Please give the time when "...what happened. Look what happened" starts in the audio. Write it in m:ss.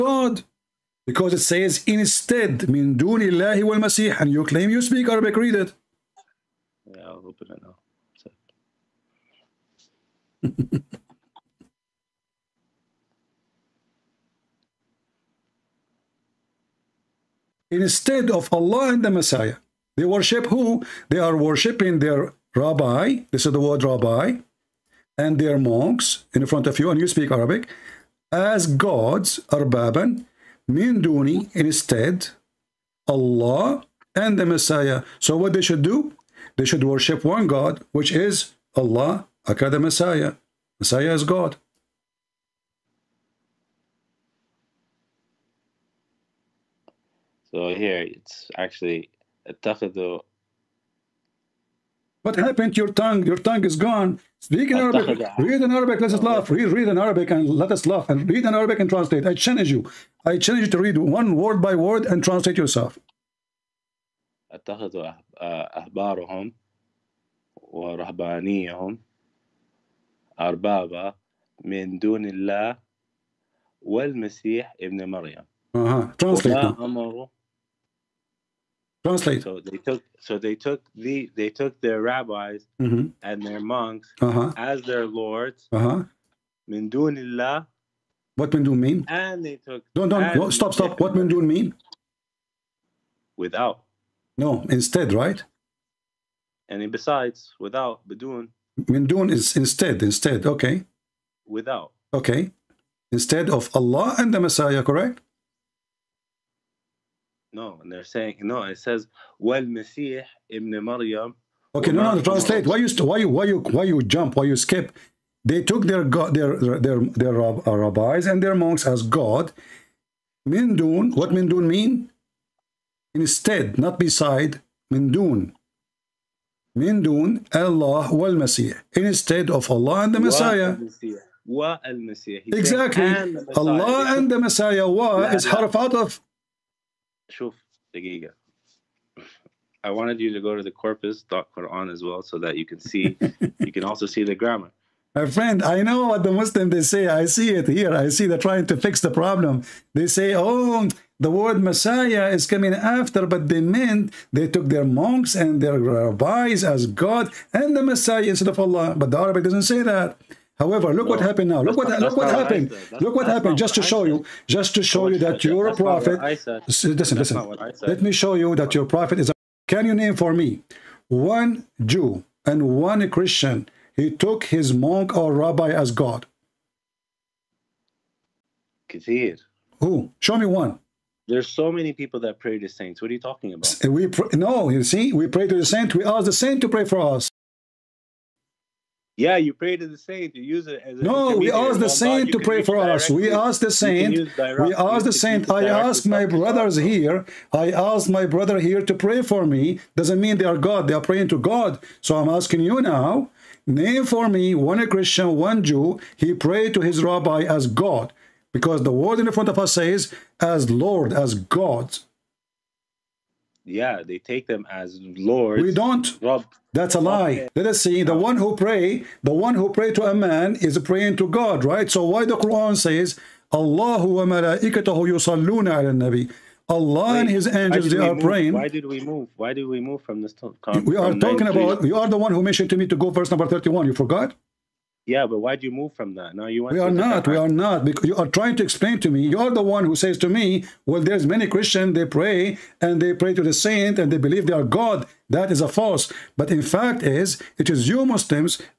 2:42.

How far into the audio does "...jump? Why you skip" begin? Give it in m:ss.
1:54.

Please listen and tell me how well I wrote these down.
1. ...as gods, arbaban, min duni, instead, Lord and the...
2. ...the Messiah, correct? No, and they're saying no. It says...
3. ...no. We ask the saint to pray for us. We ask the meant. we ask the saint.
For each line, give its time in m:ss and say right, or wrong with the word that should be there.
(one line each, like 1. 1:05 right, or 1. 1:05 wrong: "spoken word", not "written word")
1. 0:28 wrong: "Allah", not "Lord"
2. 1:44 right
3. 3:10 wrong: "saint", not "meant".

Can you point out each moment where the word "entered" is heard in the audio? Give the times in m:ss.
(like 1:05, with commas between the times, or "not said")
not said.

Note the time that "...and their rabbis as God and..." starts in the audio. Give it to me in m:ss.
2:35.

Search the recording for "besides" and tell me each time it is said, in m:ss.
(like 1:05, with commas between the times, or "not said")
1:36, 2:03.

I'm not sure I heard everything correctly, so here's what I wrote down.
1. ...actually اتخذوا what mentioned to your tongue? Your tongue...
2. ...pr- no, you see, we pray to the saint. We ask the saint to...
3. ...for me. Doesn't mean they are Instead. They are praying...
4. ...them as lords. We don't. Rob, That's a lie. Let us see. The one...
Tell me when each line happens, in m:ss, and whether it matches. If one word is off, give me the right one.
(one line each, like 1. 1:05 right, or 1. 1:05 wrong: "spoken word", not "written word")
1. 0:48 wrong: "happened", not "mentioned"
2. 3:04 right
3. 3:19 wrong: "God", not "Instead"
4. 3:34 right.